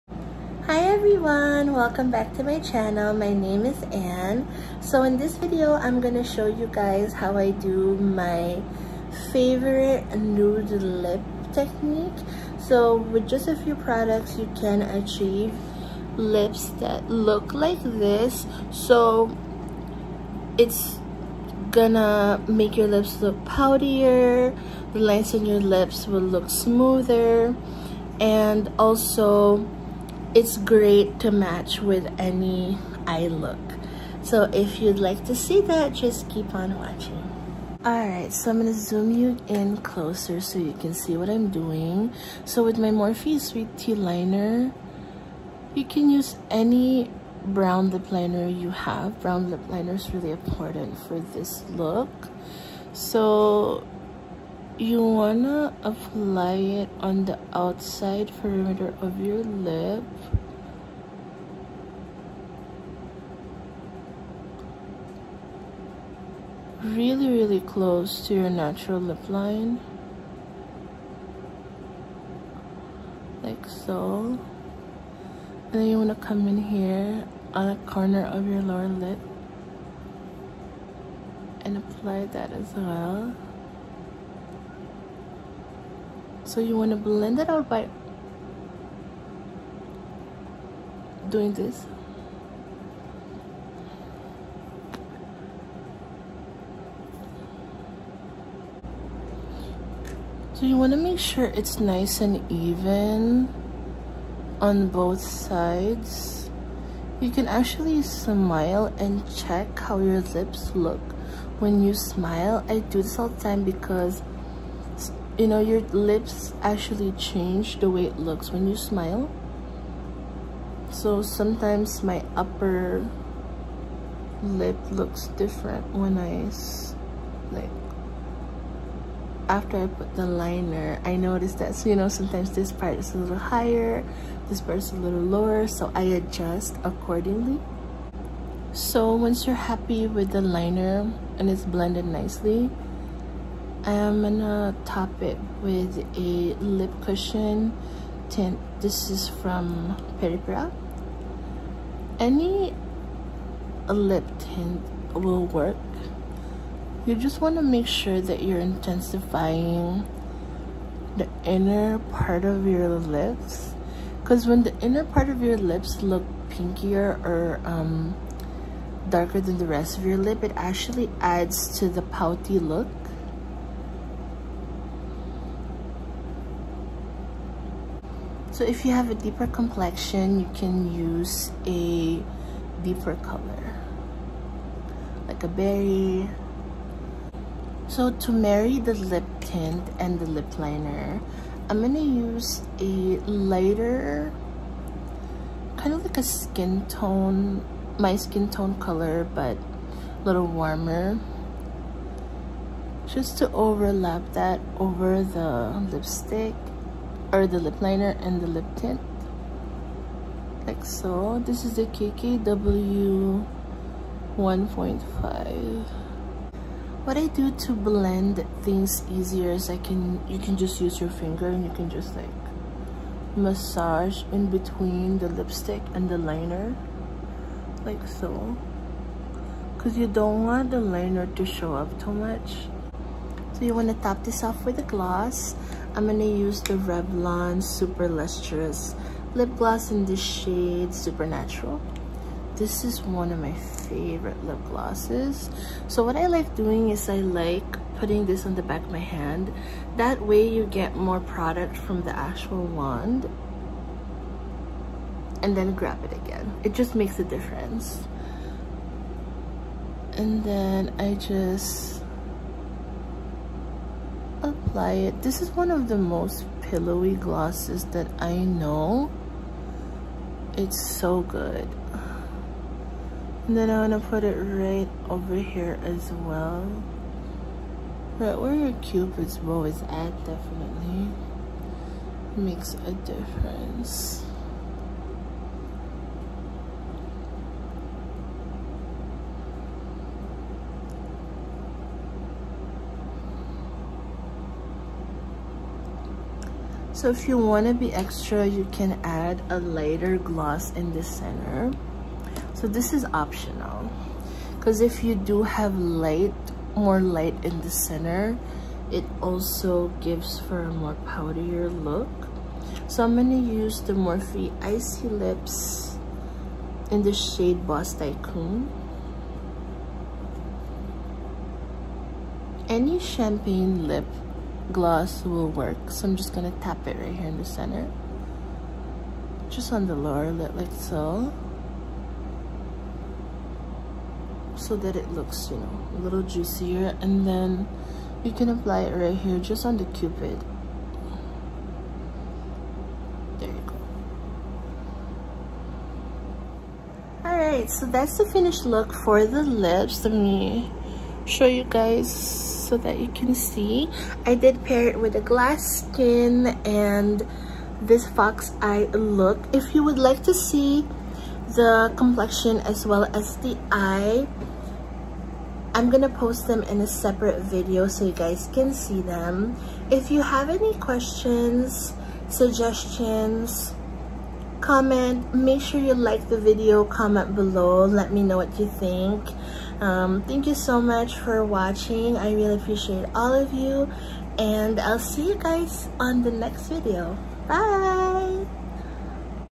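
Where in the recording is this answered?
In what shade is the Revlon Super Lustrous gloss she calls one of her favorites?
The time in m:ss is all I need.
4:00.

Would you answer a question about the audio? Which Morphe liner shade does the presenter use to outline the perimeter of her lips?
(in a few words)
Sweet Tea.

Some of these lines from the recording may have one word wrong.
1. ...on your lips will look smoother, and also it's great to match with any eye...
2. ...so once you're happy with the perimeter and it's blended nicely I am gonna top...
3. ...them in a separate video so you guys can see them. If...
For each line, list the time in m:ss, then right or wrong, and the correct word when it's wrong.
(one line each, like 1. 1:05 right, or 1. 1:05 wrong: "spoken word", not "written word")
1. 0:25 right
2. 2:18 wrong: "liner", not "perimeter"
3. 6:06 right.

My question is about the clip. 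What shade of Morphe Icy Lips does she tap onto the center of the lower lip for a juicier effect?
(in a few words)
Boss Tycoon.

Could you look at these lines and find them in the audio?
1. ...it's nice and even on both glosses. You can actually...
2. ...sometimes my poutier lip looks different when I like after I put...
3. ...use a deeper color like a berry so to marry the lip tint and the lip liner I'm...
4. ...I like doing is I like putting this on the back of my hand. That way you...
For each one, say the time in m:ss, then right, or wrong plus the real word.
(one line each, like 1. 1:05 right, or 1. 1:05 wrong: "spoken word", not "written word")
1. 1:41 wrong: "sides", not "glosses"
2. 2:01 wrong: "upper", not "poutier"
3. 3:00 right
4. 4:06 right.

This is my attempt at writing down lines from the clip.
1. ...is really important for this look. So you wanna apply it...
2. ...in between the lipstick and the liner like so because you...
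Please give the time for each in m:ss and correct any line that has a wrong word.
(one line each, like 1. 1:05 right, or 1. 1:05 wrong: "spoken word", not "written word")
1. 0:49 right
2. 3:44 right.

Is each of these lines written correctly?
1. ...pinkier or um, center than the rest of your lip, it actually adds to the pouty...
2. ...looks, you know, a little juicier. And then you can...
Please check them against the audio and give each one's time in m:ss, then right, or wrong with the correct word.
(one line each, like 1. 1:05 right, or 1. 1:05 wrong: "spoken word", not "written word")
1. 2:46 wrong: "darker", not "center"
2. 5:35 right.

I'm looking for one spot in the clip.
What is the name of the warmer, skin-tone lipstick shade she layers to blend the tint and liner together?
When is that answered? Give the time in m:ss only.
3:31.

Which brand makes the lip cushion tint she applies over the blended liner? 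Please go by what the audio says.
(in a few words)
Peripera.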